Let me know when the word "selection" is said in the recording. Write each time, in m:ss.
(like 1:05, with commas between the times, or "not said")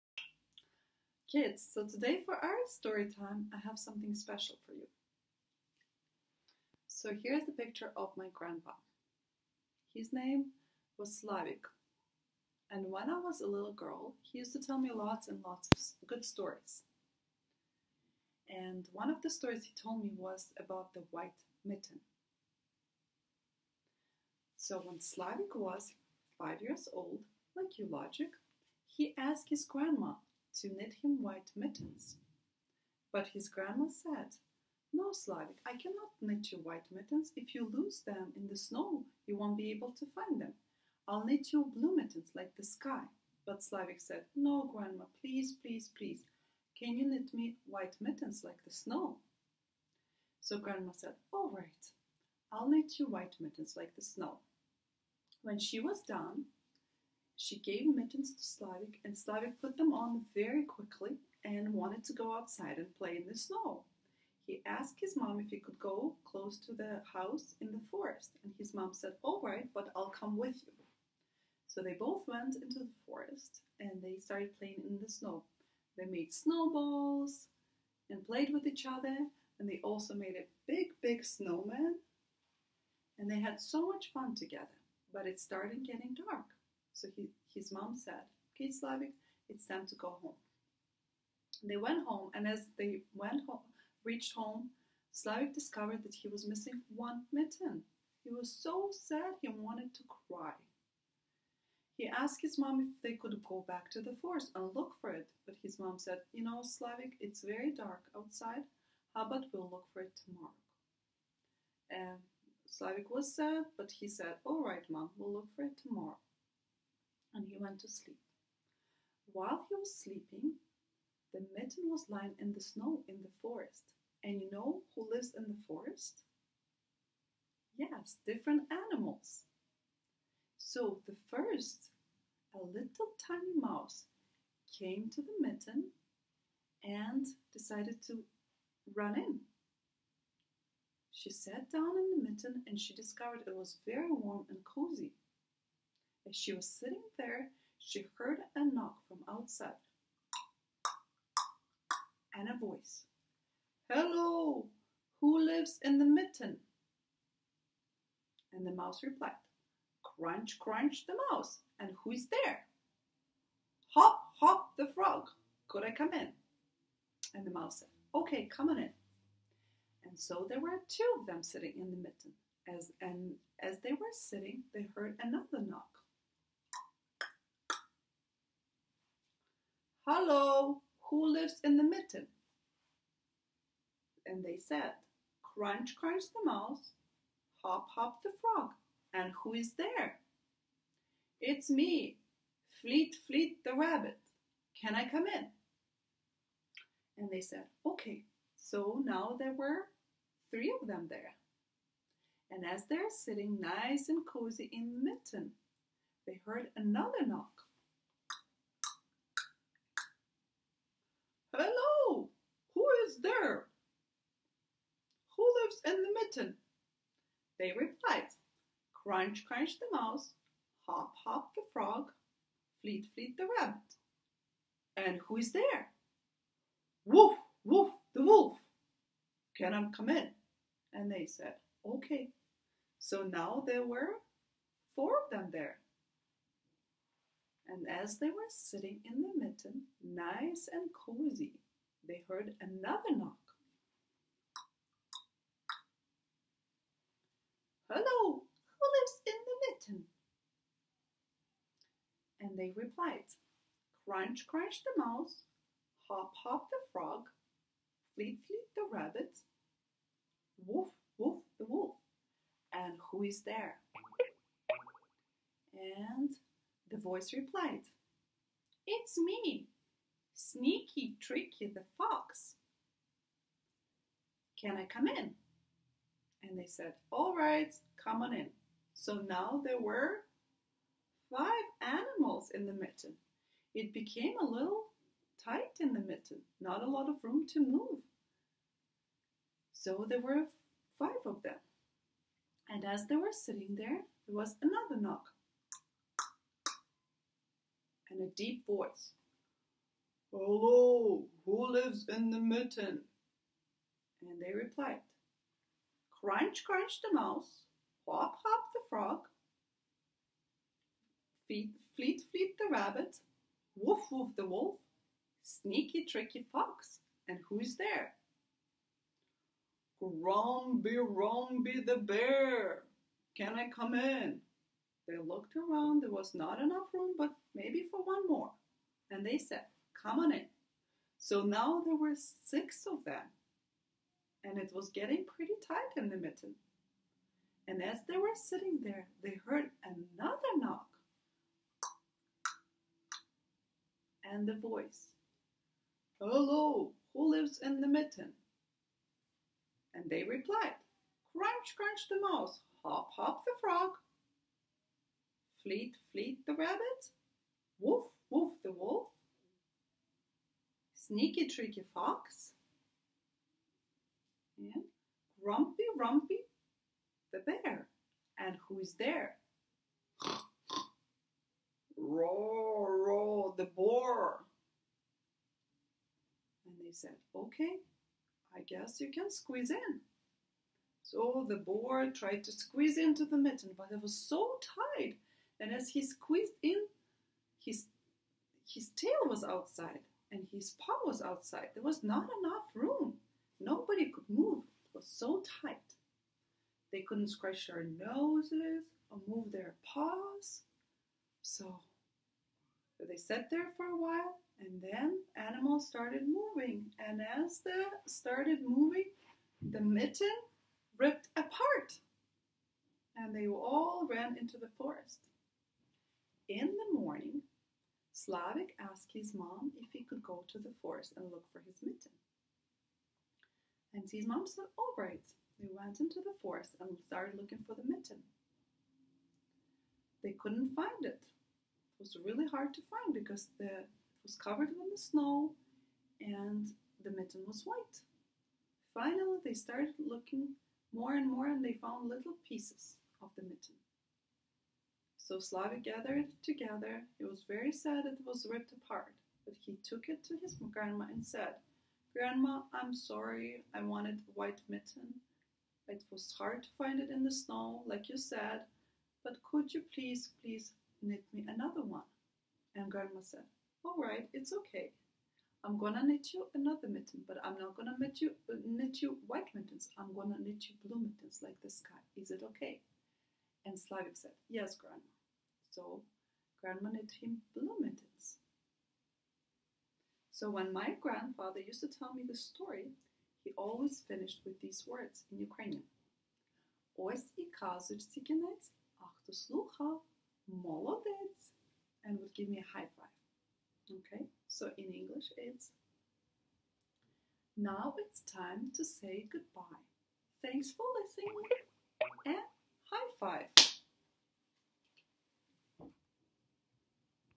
not said.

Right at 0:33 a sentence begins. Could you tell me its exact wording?
But his grandma said, No, Slavik, I cannot knit you white mittens.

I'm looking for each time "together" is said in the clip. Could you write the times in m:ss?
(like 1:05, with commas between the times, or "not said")
1:24, 7:26.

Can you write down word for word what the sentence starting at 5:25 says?
They looked around, there was not enough room, but maybe for one more.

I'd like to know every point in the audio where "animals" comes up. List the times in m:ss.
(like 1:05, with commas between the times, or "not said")
2:08, 4:41, 6:45.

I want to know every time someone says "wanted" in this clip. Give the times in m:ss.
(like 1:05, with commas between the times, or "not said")
1:01, 1:39, 7:33.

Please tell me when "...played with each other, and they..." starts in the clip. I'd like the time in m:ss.
1:18.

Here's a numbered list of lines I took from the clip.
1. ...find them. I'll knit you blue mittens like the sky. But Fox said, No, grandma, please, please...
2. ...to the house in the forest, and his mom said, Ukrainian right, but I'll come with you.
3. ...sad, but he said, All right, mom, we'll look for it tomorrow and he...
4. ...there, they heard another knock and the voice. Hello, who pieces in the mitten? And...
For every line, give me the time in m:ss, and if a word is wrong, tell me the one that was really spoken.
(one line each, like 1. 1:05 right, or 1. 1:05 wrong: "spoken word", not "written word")
1. 0:40 wrong: "Slavik", not "Fox"
2. 1:06 wrong: "All", not "Ukrainian"
3. 1:53 right
4. 5:38 wrong: "lives", not "pieces".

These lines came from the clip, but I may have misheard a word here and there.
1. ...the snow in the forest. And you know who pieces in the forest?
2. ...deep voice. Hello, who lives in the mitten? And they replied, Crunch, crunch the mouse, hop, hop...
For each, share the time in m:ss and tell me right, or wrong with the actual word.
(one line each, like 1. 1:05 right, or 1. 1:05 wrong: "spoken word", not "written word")
1. 2:02 wrong: "lives", not "pieces"
2. 4:58 right.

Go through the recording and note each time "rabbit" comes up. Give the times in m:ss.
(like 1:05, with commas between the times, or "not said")
3:13, 3:43, 4:18, 5:12, 5:56.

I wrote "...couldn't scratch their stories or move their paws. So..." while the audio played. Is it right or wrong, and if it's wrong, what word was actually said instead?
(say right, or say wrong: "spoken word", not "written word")
wrong: "noses", not "stories".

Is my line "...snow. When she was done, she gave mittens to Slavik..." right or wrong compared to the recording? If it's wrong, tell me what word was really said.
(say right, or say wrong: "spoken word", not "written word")
right.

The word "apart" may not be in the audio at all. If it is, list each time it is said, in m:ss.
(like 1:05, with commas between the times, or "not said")
6:51, 7:28.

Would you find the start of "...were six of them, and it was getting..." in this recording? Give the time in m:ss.
5:31.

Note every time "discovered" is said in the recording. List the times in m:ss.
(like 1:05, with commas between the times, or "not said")
1:35, 2:22.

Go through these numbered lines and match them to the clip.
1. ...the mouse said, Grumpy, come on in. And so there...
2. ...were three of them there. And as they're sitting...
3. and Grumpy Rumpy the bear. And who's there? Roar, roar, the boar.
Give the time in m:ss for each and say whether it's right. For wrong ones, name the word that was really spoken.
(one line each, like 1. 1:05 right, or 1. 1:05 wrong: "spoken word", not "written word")
1. 2:47 wrong: "Okay", not "Grumpy"
2. 3:19 right
3. 6:04 right.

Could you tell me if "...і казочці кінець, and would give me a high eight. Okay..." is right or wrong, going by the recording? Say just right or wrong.
wrong.